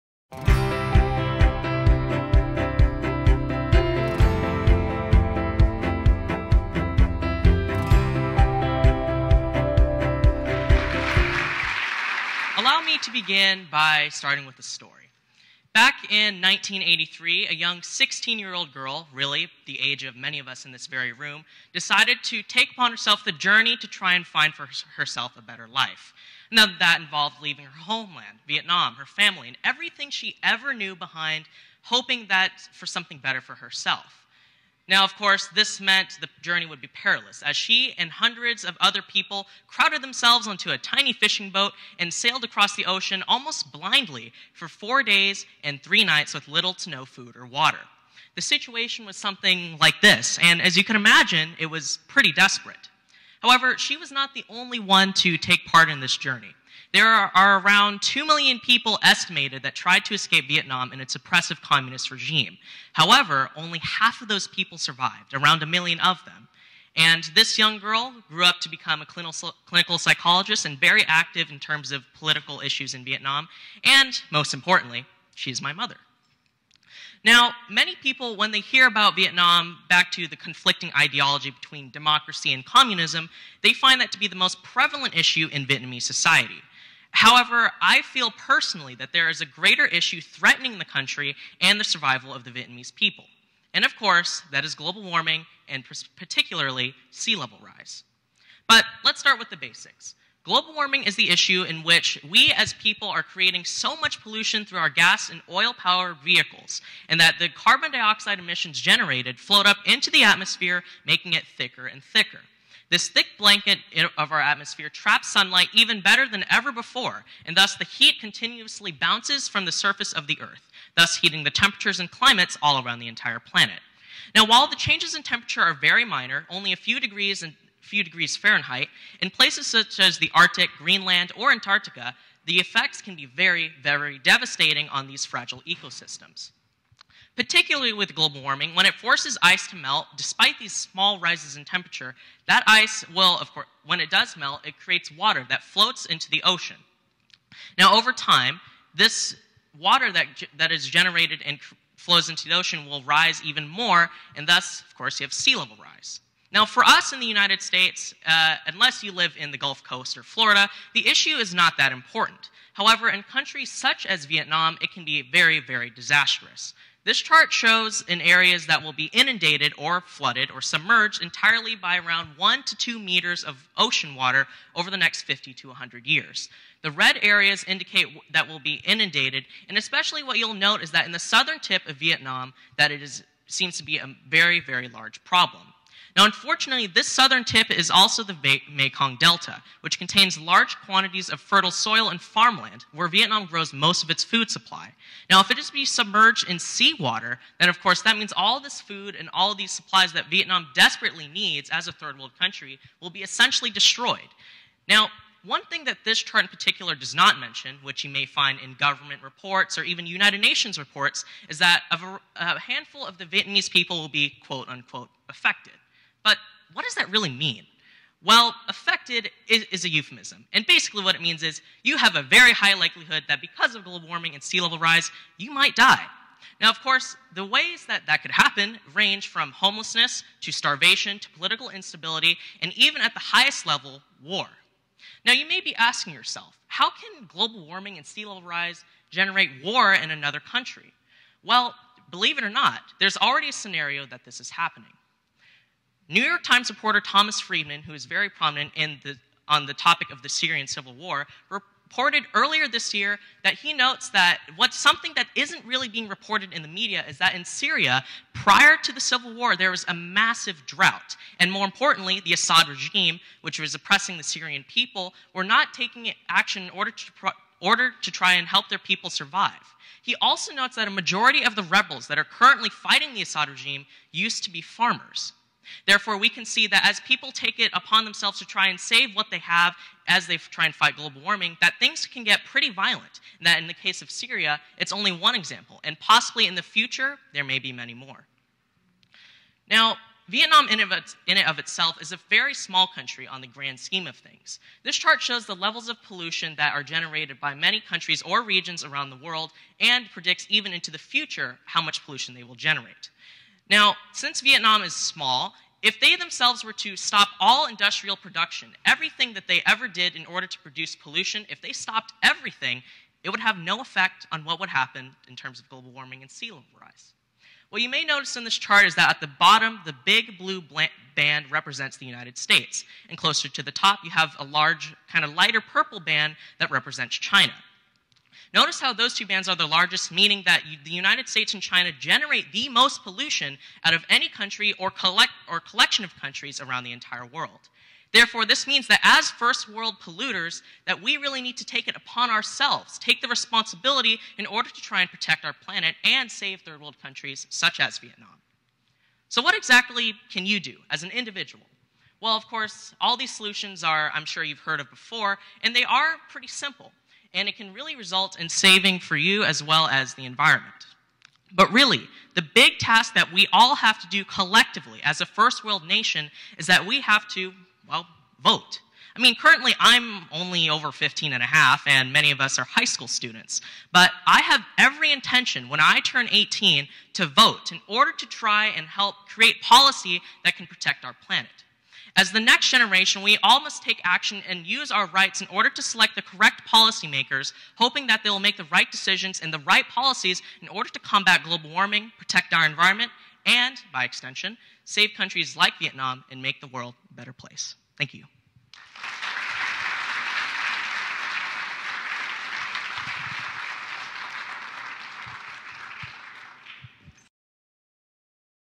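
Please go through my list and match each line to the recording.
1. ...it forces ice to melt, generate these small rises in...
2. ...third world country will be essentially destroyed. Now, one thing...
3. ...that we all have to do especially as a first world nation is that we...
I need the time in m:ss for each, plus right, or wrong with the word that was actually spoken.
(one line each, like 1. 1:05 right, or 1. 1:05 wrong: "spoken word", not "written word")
1. 2:18 wrong: "despite", not "generate"
2. 3:21 right
3. 6:03 wrong: "collectively", not "especially".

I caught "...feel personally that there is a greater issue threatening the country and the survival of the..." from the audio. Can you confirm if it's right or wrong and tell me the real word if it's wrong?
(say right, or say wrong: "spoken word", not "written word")
right.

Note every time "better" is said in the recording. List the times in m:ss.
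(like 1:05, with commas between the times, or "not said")
0:25, 0:33, 1:56, 6:37.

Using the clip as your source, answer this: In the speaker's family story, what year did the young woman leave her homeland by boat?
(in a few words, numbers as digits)
1983.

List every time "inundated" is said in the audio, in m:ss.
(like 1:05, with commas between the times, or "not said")
2:49, 2:58.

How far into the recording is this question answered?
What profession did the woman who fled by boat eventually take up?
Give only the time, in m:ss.
1:09.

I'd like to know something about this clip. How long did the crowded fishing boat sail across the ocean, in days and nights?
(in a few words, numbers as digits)
4 days and 3 nights.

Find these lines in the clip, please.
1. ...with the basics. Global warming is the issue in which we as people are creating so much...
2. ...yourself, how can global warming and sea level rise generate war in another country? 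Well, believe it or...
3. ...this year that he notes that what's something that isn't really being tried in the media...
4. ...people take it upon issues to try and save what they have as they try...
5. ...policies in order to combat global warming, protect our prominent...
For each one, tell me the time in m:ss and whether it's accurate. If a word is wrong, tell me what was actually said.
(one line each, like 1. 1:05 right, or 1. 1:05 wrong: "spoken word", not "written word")
1. 1:39 right
2. 3:56 right
3. 4:12 wrong: "reported", not "tried"
4. 4:37 wrong: "themselves", not "issues"
5. 6:29 wrong: "environment", not "prominent".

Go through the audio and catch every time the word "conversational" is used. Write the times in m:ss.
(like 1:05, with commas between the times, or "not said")
not said.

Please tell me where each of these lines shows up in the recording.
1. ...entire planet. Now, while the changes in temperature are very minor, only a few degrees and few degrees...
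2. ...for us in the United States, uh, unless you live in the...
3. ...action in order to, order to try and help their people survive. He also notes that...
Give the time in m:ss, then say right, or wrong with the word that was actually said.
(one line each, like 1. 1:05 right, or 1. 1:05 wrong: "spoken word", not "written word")
1. 2:03 right
2. 2:36 right
3. 4:26 right.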